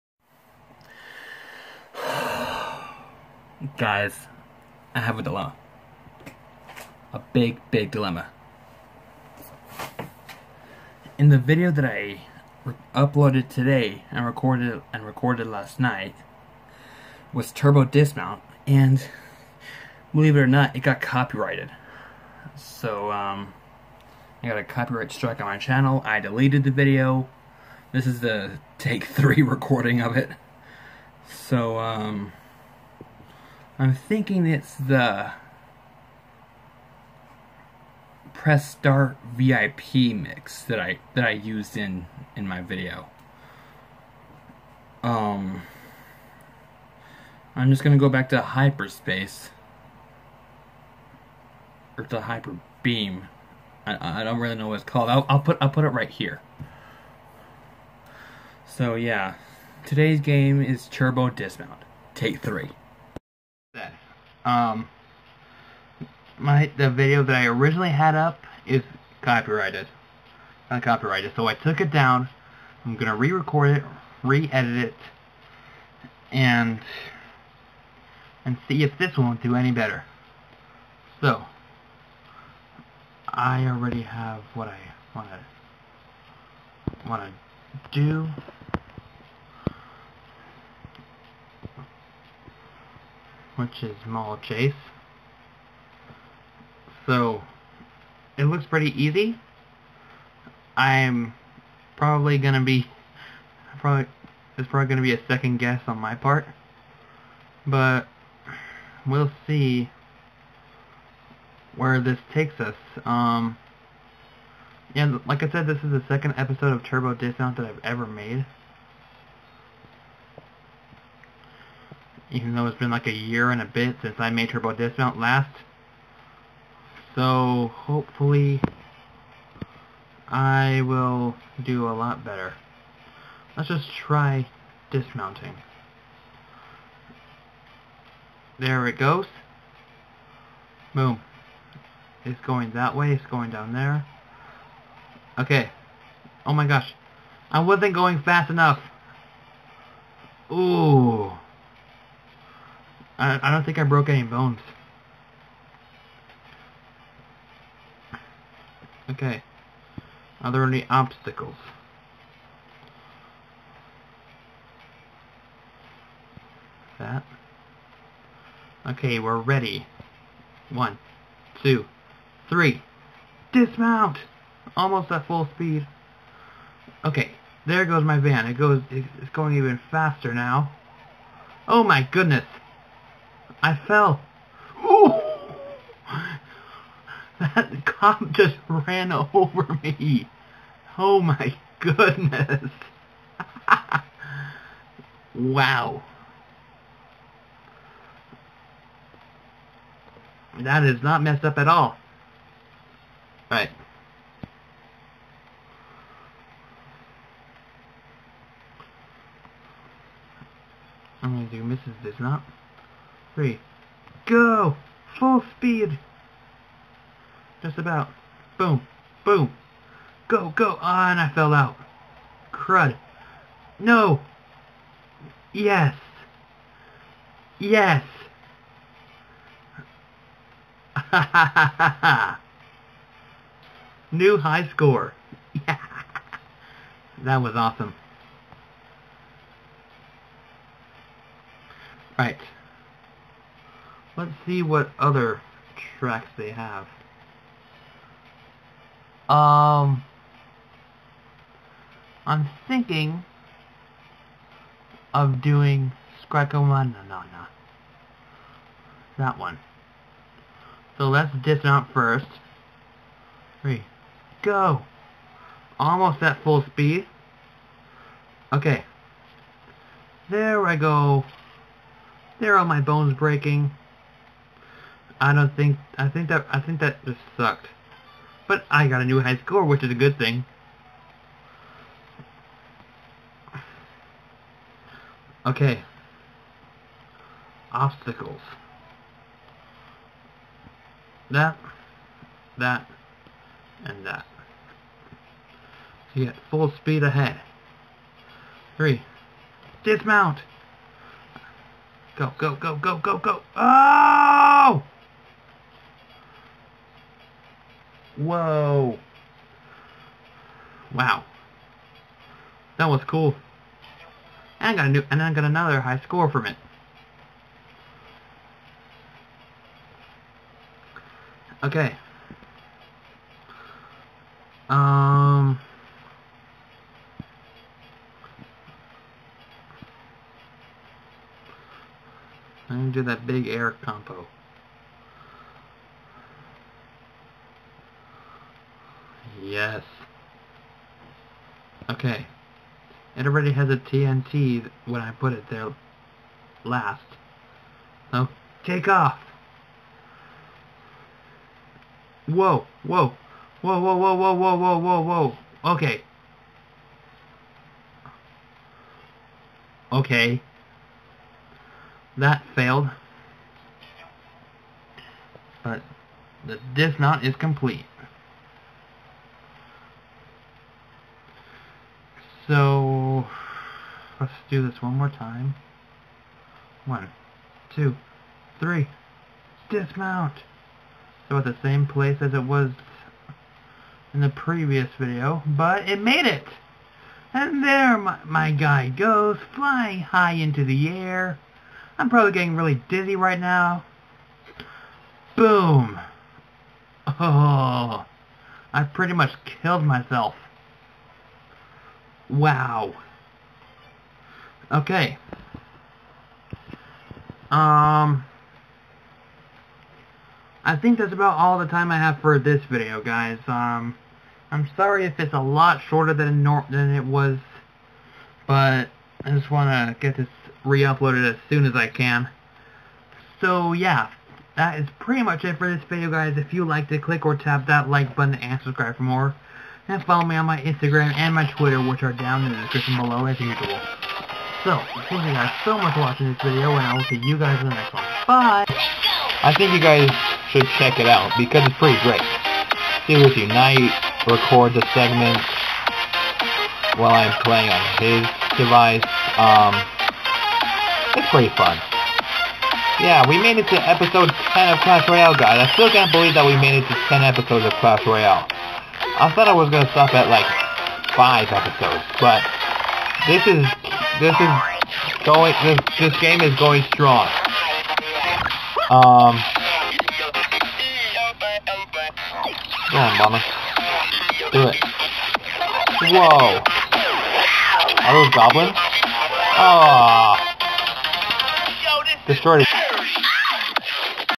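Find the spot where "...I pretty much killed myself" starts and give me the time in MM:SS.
06:38.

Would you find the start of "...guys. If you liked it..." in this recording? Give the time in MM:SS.
07:06.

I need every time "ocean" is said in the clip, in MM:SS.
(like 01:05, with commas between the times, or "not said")
not said.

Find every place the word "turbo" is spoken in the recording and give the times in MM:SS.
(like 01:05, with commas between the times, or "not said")
00:17, 01:00, 01:56, 02:04.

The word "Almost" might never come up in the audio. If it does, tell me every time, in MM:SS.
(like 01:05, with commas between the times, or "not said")
02:54, 04:25.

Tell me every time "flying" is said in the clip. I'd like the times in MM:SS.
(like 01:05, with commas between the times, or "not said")
06:29.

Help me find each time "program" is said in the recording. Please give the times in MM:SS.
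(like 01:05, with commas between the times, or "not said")
not said.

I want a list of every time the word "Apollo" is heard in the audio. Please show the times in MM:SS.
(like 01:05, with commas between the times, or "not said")
not said.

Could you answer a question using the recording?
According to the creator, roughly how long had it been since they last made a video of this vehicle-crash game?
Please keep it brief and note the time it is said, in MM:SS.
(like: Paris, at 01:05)
a year and a bit, at 02:03.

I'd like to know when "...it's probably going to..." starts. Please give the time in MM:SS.
01:44.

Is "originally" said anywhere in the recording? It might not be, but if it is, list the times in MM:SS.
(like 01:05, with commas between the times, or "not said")
01:07.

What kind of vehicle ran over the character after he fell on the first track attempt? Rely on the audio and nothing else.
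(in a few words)
cop.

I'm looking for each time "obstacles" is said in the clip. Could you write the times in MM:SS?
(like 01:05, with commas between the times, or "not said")
02:40, 04:47.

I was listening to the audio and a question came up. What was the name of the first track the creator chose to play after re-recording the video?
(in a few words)
Mall Chase.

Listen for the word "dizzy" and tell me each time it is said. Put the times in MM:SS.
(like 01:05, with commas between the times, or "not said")
06:32.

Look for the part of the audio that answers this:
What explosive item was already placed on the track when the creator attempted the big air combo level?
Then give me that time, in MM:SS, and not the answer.
05:43.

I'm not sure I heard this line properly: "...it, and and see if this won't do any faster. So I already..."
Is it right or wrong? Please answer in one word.
wrong.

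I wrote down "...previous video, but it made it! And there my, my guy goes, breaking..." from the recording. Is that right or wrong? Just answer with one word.
wrong.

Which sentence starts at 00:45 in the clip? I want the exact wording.
Um I'm just going to go back to hyperspace or to hyper beam.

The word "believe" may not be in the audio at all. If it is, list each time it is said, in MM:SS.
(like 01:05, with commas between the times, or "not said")
00:20, 07:36.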